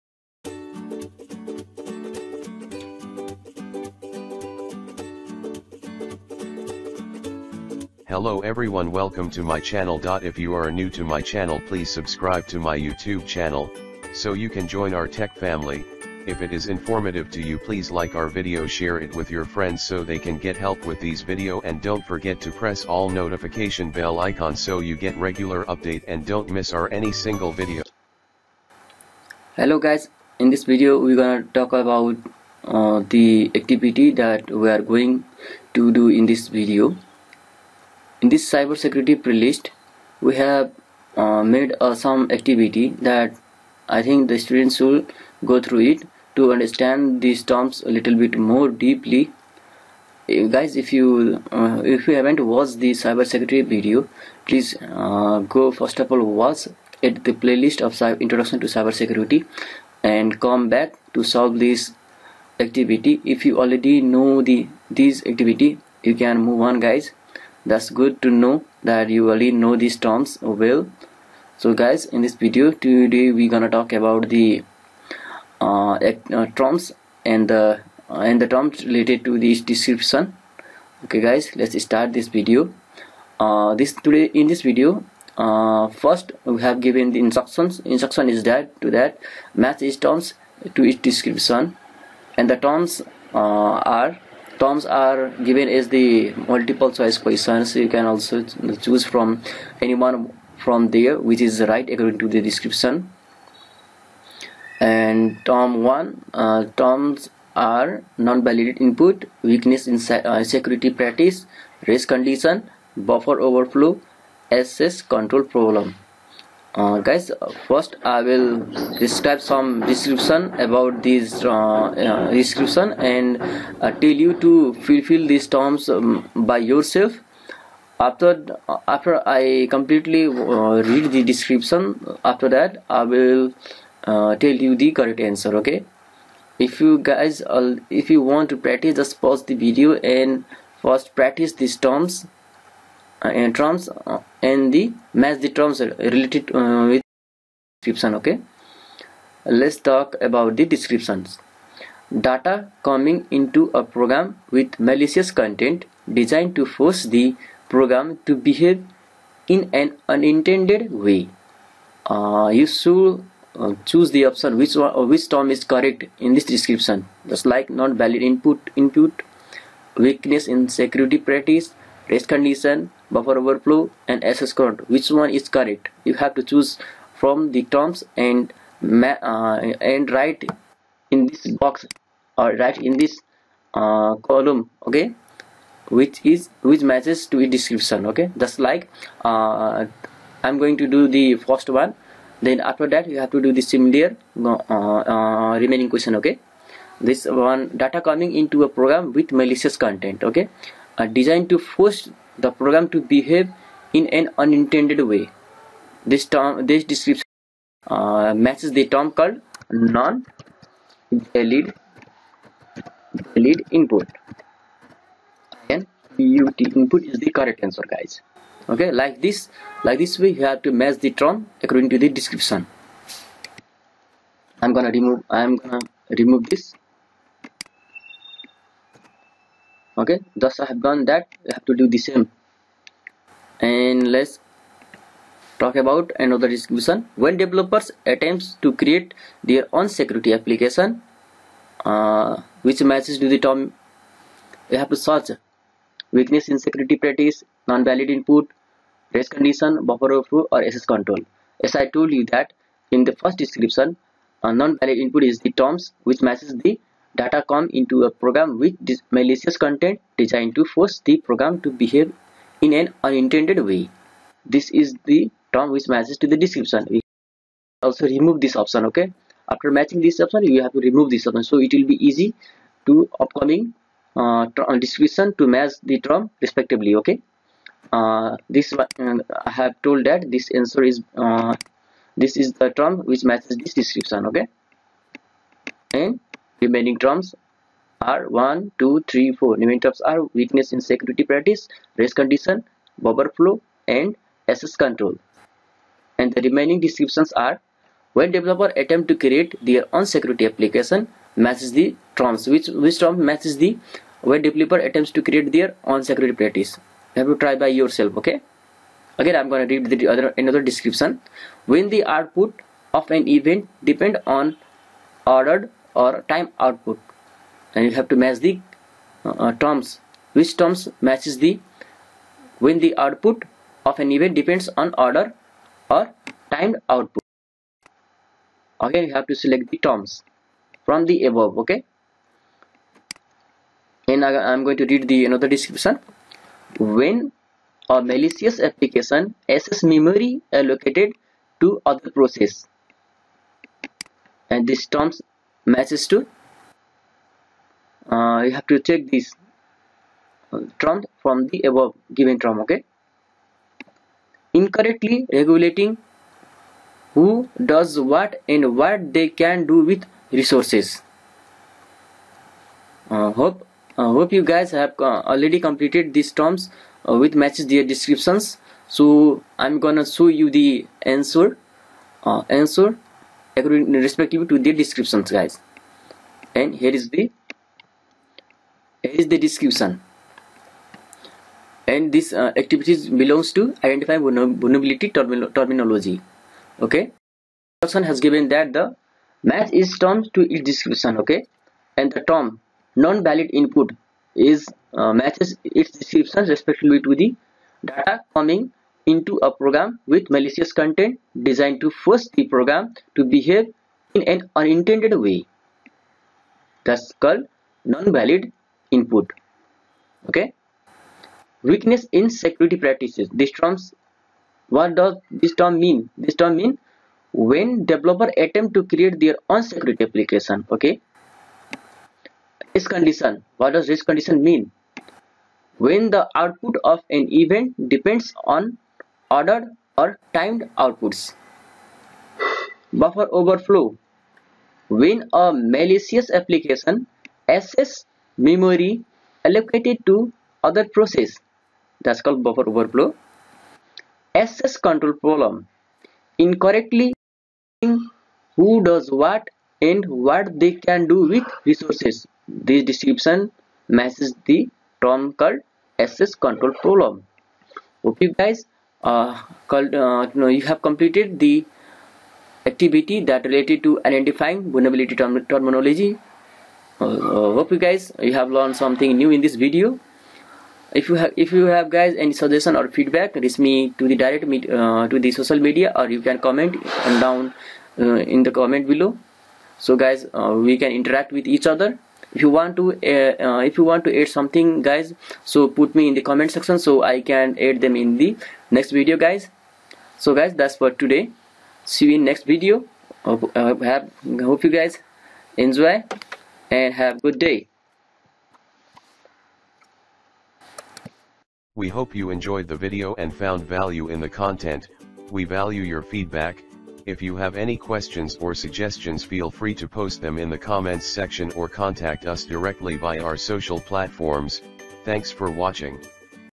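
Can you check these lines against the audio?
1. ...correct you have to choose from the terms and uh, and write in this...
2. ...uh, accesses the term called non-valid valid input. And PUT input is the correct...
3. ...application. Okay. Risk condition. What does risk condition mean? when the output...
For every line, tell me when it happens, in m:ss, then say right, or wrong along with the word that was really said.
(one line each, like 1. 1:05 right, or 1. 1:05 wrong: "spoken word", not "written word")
1. 2:55 right
2. 3:27 wrong: "matches", not "accesses"
3. 7:00 right.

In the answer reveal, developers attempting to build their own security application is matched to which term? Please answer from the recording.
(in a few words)
Weakness in security practices.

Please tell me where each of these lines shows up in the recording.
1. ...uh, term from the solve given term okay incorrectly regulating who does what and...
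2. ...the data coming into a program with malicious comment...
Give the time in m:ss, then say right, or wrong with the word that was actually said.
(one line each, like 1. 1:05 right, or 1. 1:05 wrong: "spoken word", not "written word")
1. 5:50 wrong: "above", not "solve"
2. 6:37 wrong: "content", not "comment".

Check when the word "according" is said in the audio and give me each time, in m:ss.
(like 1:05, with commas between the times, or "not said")
1:41, 3:41, 6:13.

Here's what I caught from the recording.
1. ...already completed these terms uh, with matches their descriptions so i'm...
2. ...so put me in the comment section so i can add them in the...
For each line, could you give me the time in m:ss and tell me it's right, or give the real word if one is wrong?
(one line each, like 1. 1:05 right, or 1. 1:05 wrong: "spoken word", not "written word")
1. 6:05 right
2. 8:05 right.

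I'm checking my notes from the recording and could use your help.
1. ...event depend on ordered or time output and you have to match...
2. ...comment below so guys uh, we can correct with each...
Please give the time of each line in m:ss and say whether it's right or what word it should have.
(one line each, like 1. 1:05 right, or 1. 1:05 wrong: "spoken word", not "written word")
1. 5:13 right
2. 7:58 wrong: "interact", not "correct".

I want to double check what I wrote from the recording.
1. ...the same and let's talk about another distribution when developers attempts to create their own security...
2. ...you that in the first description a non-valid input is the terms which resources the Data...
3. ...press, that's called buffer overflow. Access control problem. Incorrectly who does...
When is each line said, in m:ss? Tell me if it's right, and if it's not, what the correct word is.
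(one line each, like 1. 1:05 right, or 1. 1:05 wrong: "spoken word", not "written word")
1. 3:51 right
2. 4:12 wrong: "matches", not "resources"
3. 7:20 wrong: "process", not "press".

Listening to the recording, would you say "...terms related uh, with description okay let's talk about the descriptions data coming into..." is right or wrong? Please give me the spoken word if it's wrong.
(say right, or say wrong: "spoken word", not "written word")
right.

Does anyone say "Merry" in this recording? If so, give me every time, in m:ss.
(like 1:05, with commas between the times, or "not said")
not said.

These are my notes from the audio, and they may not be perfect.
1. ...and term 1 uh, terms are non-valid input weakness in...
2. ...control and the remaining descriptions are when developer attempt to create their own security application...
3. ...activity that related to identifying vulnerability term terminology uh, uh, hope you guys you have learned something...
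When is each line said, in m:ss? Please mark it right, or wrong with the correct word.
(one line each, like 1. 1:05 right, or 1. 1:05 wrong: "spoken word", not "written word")
1. 1:44 right
2. 4:54 right
3. 7:42 right.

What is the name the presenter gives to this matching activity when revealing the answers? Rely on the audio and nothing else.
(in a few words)
Identify vulnerability terminology.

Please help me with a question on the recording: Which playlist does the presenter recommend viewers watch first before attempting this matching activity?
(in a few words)
Introduction to cybersecurity.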